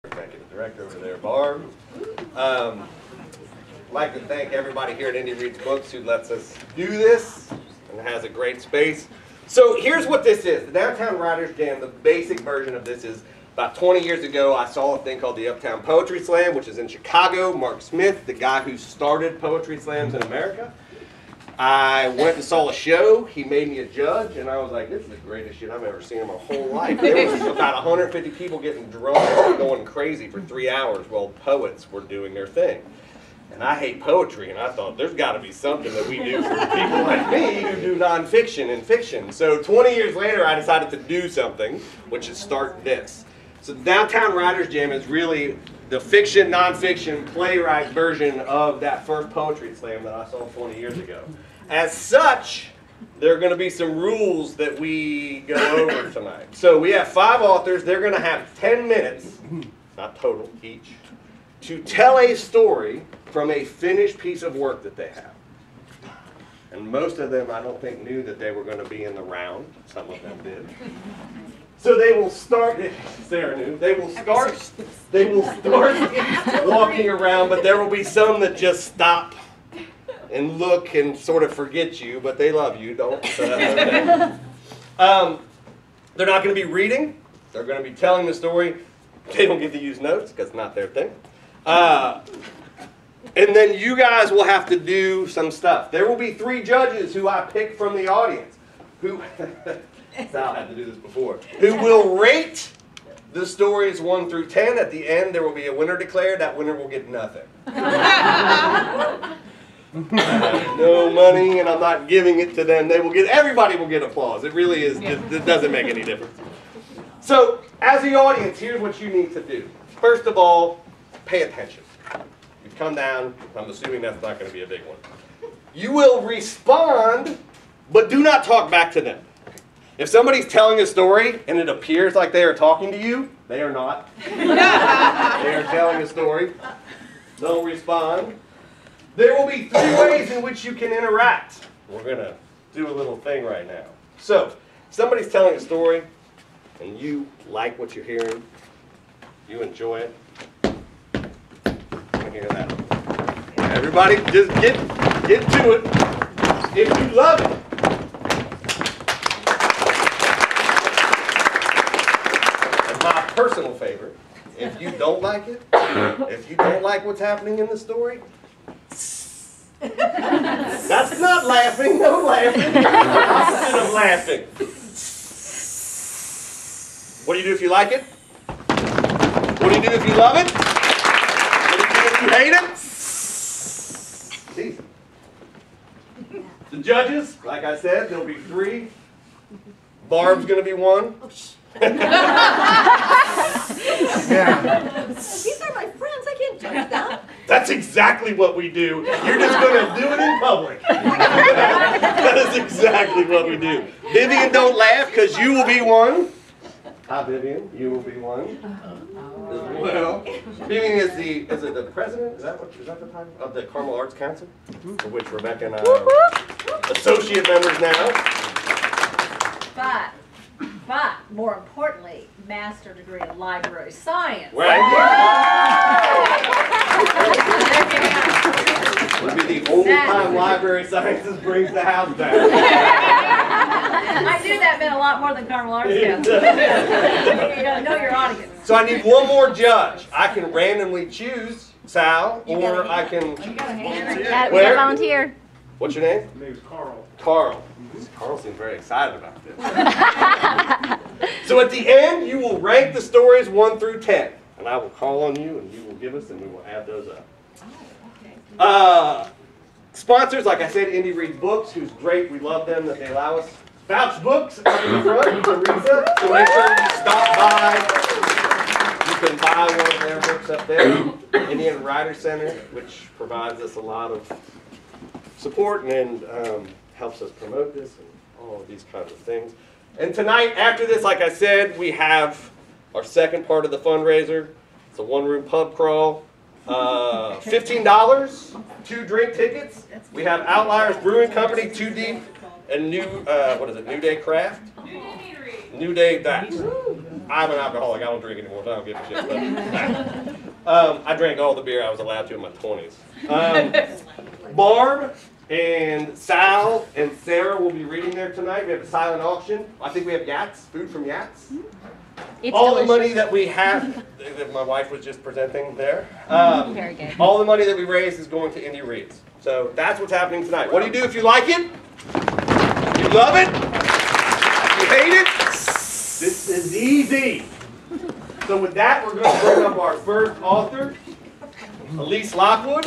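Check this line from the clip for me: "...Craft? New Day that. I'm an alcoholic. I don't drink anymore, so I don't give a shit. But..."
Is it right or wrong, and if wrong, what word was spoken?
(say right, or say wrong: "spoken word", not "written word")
right.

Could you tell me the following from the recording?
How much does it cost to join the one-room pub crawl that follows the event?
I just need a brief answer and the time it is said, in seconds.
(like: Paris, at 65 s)
$15, at 287 s.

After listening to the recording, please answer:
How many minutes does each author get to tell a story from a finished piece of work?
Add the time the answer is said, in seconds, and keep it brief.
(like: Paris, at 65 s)
10, at 58 s.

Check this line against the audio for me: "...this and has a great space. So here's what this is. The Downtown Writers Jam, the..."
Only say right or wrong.
right.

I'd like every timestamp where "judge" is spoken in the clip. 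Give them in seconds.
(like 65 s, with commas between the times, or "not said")
23 s, 96 s, 186 s, 196 s, 239 s.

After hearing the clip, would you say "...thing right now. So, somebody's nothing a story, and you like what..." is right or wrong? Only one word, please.
wrong.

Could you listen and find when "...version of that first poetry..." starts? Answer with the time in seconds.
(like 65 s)
47 s.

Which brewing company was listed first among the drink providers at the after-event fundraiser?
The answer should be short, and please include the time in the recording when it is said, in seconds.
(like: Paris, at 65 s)
Outliers Brewing Company, at 290 s.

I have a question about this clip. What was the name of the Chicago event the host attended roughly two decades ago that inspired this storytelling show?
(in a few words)
Uptown Poetry Slam.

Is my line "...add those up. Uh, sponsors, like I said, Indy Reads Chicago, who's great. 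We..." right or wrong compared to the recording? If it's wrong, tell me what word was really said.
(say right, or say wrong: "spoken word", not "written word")
wrong: "Books", not "Chicago".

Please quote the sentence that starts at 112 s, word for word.
They will get everybody will get applause.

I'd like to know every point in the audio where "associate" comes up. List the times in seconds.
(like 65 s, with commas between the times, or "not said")
216 s.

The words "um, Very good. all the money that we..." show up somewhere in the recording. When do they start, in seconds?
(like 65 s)
316 s.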